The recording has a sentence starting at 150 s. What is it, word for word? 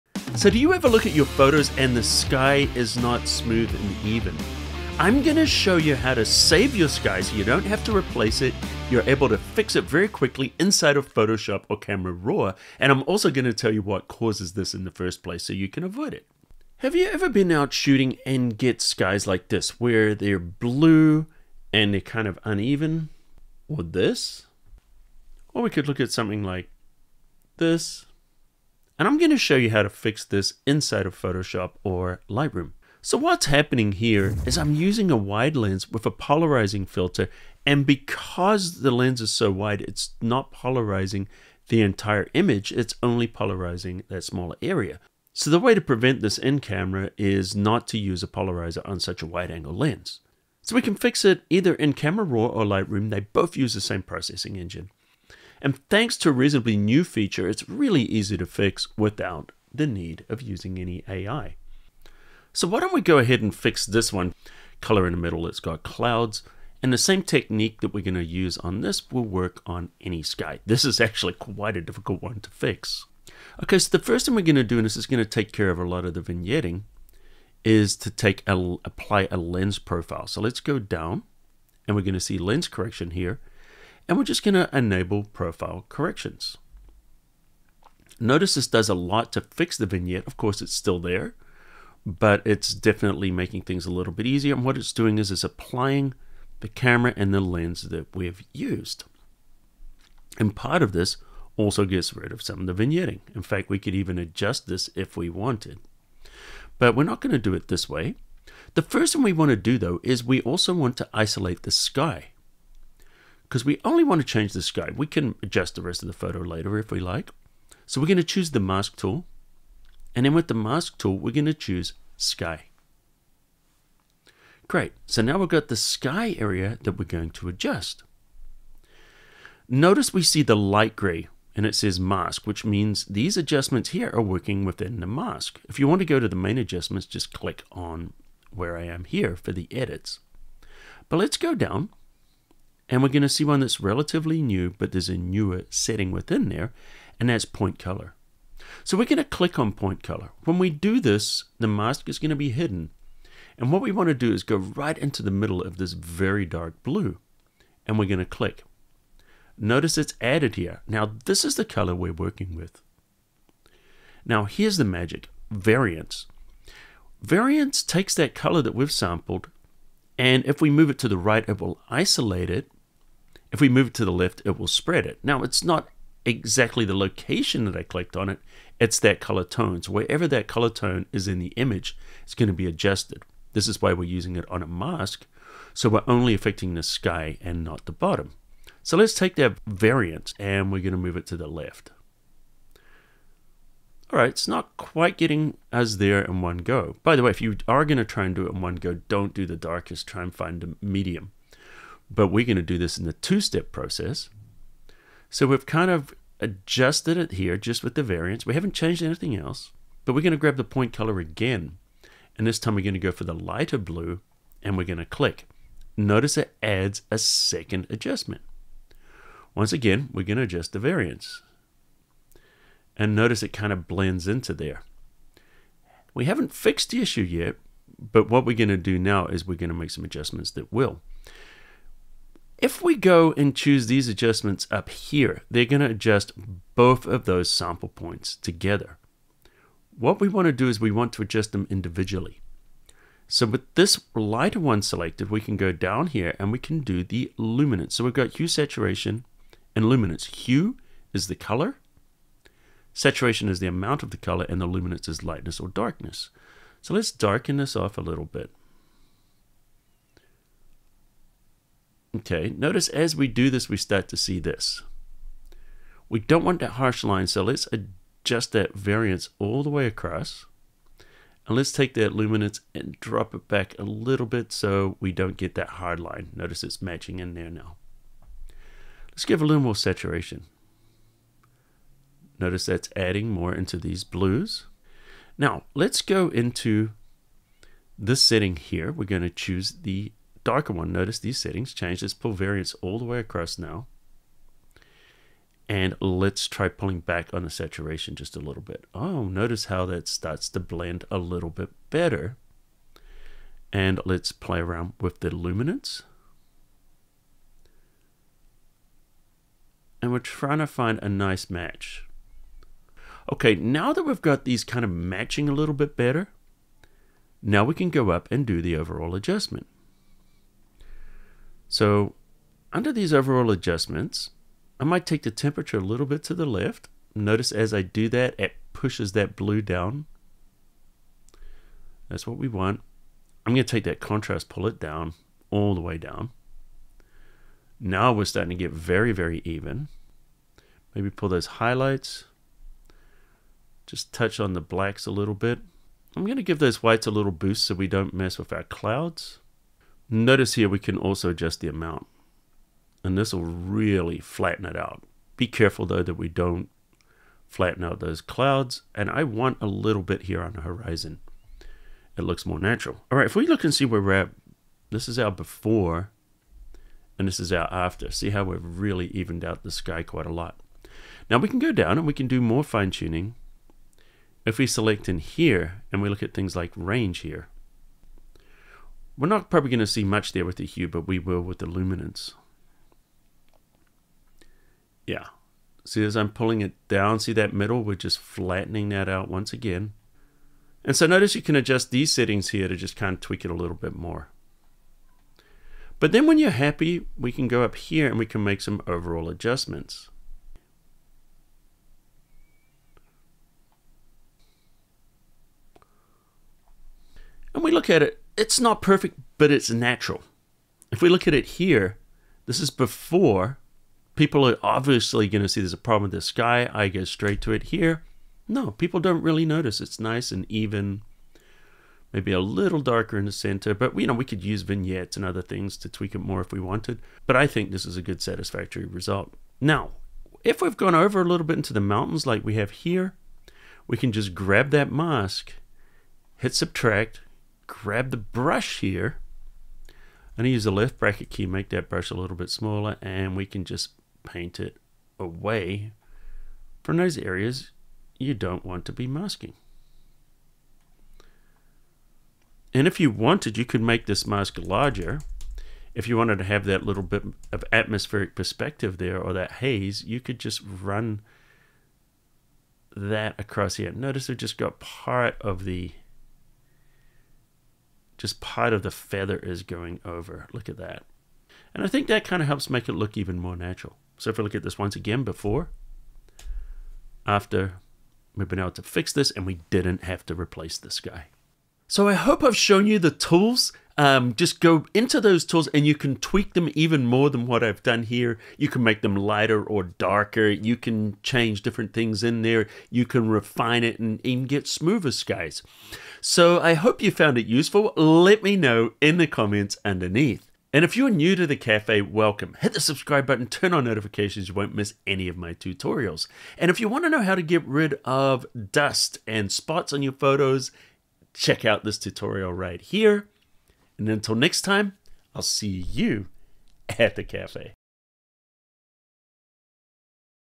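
When we do this, the mask is going to be hidden.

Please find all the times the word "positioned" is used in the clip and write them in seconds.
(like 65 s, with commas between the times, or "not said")
not said.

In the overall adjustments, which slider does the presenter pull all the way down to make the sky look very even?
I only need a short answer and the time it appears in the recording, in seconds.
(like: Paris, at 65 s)
Contrast, at 334 s.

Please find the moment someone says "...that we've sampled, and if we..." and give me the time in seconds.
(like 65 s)
168 s.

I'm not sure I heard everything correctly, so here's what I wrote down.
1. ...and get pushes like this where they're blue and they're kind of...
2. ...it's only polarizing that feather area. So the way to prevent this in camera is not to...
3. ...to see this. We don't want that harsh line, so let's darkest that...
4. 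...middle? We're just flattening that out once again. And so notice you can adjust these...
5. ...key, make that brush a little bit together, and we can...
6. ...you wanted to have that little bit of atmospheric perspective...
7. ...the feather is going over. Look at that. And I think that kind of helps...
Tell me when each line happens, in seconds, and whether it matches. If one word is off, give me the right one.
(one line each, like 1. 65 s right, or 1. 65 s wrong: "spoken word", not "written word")
1. 18 s wrong: "skies", not "pushes"
2. 42 s wrong: "smaller", not "feather"
3. 264 s wrong: "adjust", not "darkest"
4. 387 s right
5. 441 s wrong: "smaller", not "together"
6. 456 s right
7. 468 s right.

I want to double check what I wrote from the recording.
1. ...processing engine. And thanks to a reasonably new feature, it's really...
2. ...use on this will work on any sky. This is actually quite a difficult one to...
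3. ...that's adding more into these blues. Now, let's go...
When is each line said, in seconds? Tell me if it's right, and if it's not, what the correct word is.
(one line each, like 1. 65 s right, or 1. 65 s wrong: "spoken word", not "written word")
1. 54 s right
2. 68 s right
3. 282 s right.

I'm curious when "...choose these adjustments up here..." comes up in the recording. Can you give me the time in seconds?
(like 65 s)
233 s.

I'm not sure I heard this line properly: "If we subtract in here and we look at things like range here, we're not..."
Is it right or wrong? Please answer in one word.
wrong.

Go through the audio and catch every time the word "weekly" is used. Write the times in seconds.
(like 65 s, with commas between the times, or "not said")
not said.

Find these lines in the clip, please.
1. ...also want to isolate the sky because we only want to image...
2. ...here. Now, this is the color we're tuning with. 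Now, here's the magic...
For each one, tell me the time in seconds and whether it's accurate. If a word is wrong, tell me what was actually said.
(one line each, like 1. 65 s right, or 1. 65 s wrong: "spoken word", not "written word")
1. 110 s wrong: "change", not "image"
2. 160 s wrong: "working", not "tuning".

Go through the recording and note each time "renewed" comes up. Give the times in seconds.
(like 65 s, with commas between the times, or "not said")
not said.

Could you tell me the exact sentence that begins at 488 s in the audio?
You can make them lighter or darker.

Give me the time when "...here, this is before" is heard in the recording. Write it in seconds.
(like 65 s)
411 s.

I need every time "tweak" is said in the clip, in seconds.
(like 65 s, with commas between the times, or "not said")
393 s, 425 s, 486 s.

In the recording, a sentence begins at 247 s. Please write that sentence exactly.
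So we've got hue, saturation, and luminance.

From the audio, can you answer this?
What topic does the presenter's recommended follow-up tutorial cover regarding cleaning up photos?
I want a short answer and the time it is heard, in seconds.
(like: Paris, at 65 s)
Dust and spots, at 508 s.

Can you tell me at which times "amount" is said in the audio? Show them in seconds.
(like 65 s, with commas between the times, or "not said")
253 s, 351 s.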